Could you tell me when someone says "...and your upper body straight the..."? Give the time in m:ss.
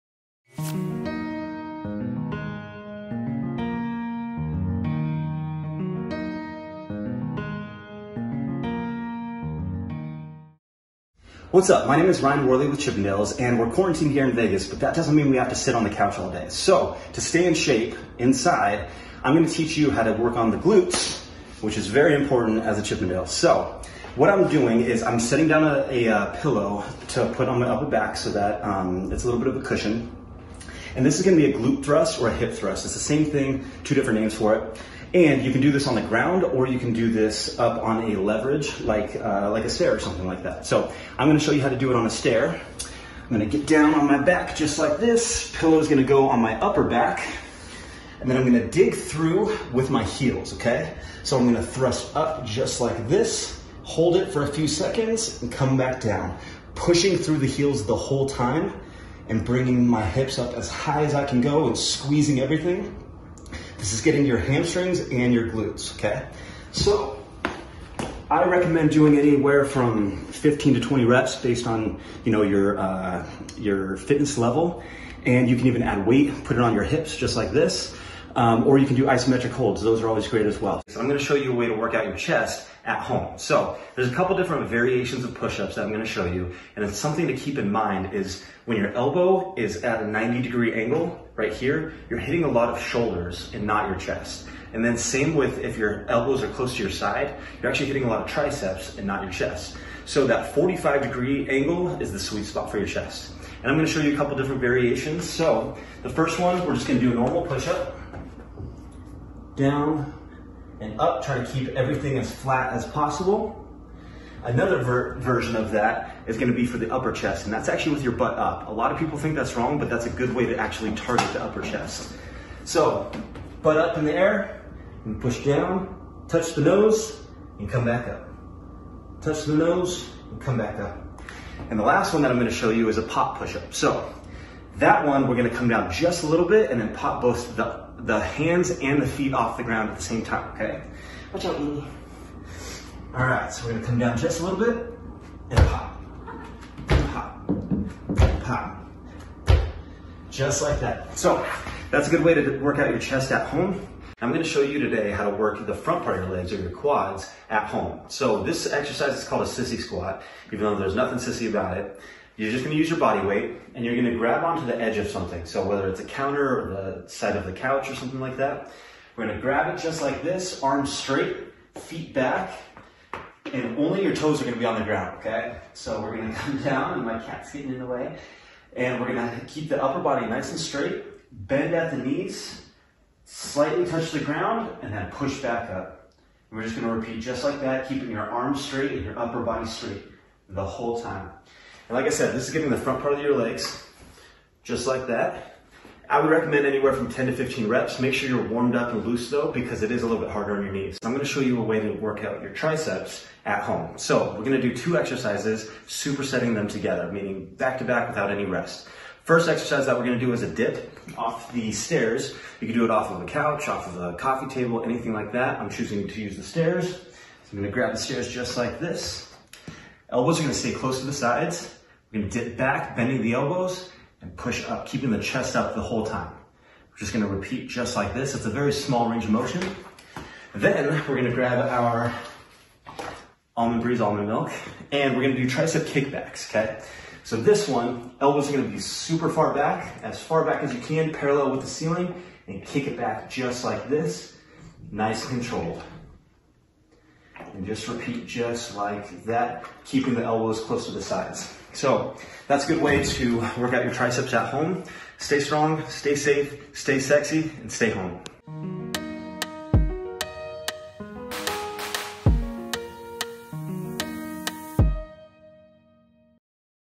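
3:08.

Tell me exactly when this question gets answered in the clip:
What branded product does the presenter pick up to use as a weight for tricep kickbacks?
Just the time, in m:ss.
3:53.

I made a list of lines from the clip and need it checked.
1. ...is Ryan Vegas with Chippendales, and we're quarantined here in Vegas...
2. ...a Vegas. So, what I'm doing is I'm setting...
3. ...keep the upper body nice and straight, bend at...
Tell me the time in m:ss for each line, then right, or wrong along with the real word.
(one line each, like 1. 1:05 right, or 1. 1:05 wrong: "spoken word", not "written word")
1. 0:12 wrong: "Worley", not "Vegas"
2. 0:22 wrong: "Chippendale", not "Vegas"
3. 2:59 right.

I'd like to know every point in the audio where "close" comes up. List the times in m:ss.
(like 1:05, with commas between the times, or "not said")
1:36, 3:40, 4:10.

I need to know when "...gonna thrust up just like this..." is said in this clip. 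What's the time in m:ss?
0:51.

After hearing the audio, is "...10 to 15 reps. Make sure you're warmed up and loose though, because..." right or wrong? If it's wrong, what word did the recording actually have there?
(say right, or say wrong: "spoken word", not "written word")
right.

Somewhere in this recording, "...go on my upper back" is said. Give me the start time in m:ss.
0:46.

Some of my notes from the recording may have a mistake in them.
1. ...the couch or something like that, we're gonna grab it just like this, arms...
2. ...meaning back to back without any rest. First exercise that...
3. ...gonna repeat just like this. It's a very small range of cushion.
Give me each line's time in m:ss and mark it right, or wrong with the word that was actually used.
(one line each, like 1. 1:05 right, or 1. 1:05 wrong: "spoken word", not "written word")
1. 2:47 right
2. 3:27 right
3. 3:47 wrong: "motion", not "cushion".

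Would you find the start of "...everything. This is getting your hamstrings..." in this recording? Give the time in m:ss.
1:02.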